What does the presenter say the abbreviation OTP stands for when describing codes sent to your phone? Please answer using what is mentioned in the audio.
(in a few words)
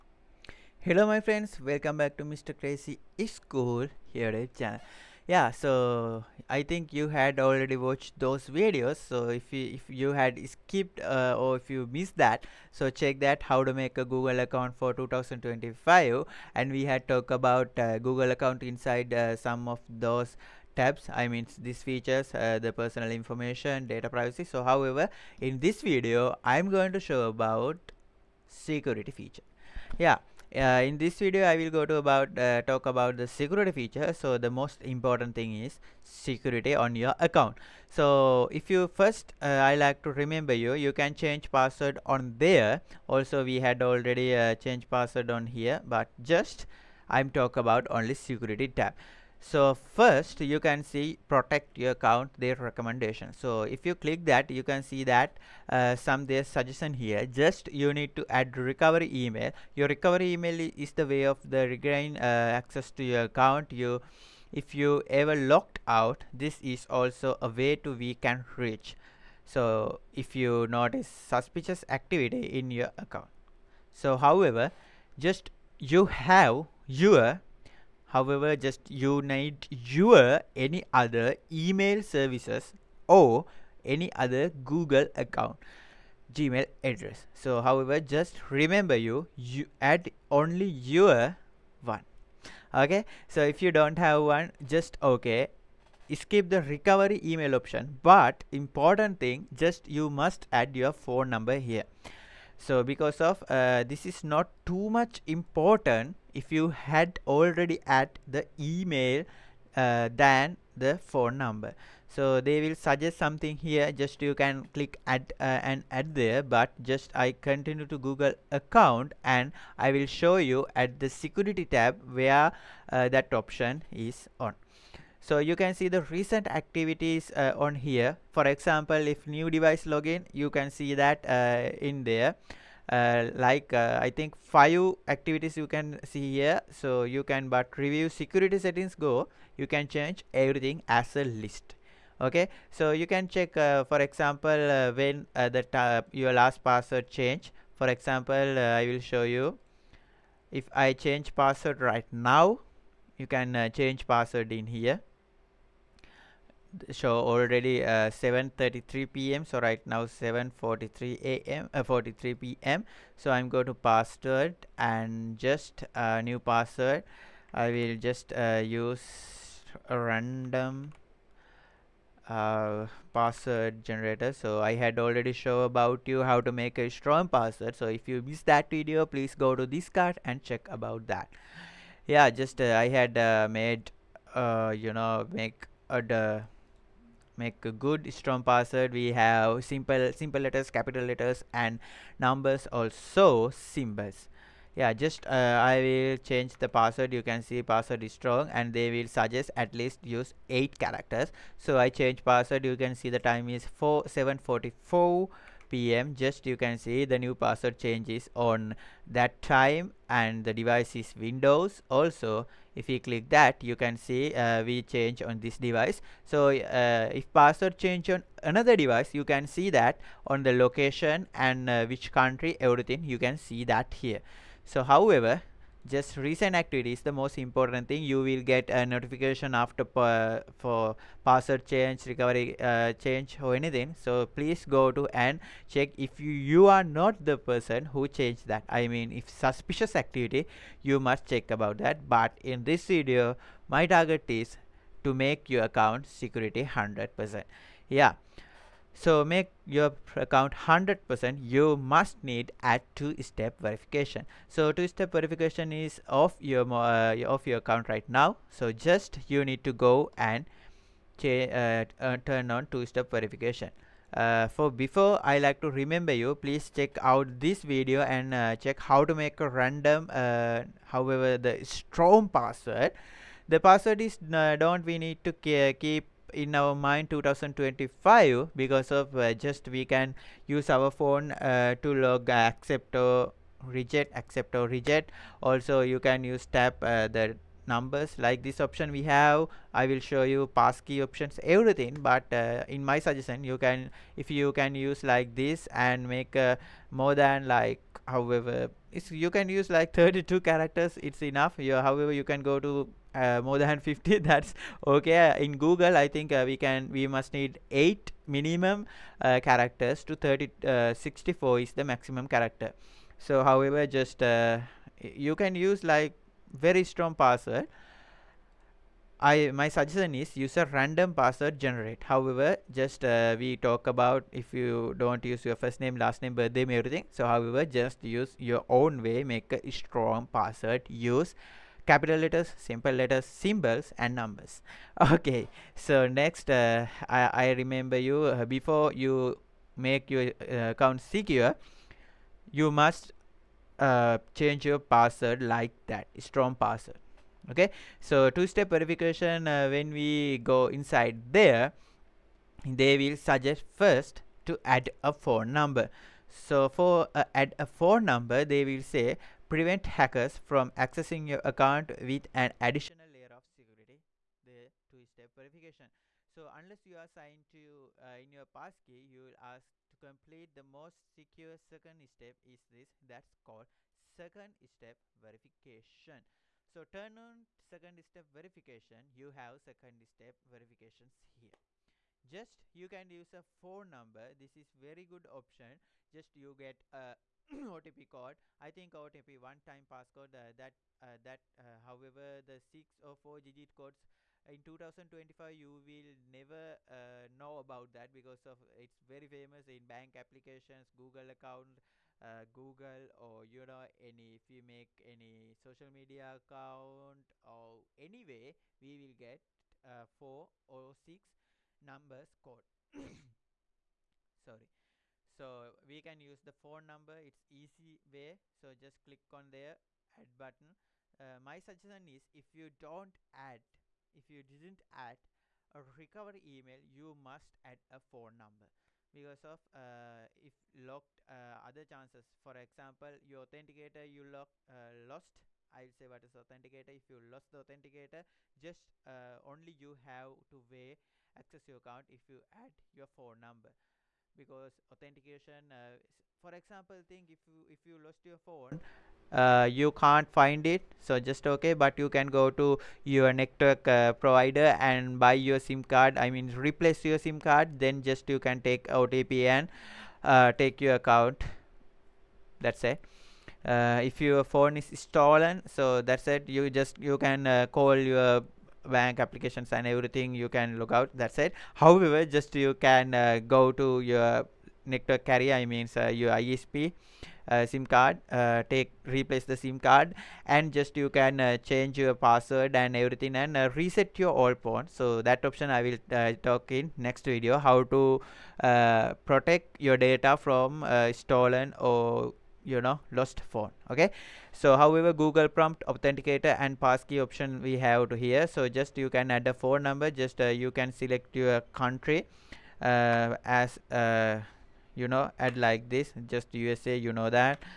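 one time passcode.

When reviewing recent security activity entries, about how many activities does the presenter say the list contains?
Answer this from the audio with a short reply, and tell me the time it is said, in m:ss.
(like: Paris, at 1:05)
5, at 2:14.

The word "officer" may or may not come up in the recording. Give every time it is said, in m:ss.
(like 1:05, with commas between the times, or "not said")
not said.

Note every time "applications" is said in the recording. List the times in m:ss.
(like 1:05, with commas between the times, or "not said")
6:40, 7:49.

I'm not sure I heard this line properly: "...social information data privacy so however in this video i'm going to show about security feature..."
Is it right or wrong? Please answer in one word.
wrong.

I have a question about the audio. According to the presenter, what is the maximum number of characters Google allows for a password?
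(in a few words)
64.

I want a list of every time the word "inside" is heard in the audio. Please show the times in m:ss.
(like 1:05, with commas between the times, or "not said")
0:18, 5:50.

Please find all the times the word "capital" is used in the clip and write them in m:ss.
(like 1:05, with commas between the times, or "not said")
3:10, 5:31.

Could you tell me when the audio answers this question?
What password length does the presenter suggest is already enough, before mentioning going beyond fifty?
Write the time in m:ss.
4:59.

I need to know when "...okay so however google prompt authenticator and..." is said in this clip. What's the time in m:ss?
8:13.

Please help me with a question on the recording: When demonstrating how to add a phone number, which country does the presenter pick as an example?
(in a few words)
USA.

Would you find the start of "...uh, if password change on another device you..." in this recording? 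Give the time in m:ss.
3:36.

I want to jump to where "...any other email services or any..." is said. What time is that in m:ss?
1:20.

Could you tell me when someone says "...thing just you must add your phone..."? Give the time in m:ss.
1:39.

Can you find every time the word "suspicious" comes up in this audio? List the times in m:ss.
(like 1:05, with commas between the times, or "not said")
1:11, 3:59.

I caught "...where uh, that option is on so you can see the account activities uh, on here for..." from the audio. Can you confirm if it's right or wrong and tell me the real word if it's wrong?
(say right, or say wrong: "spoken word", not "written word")
wrong: "recent", not "account".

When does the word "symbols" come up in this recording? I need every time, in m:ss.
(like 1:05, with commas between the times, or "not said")
3:13, 5:33.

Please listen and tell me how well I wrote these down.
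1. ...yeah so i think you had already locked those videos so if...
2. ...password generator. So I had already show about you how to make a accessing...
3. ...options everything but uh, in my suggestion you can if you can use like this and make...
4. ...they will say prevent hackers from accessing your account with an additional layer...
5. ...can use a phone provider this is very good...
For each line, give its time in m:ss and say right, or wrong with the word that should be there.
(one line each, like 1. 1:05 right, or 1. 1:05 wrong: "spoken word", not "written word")
1. 0:05 wrong: "watched", not "locked"
2. 2:53 wrong: "strong", not "accessing"
3. 4:51 right
4. 5:58 right
5. 6:22 wrong: "number", not "provider".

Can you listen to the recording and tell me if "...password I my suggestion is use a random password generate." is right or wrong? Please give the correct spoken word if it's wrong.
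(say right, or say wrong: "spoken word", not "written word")
right.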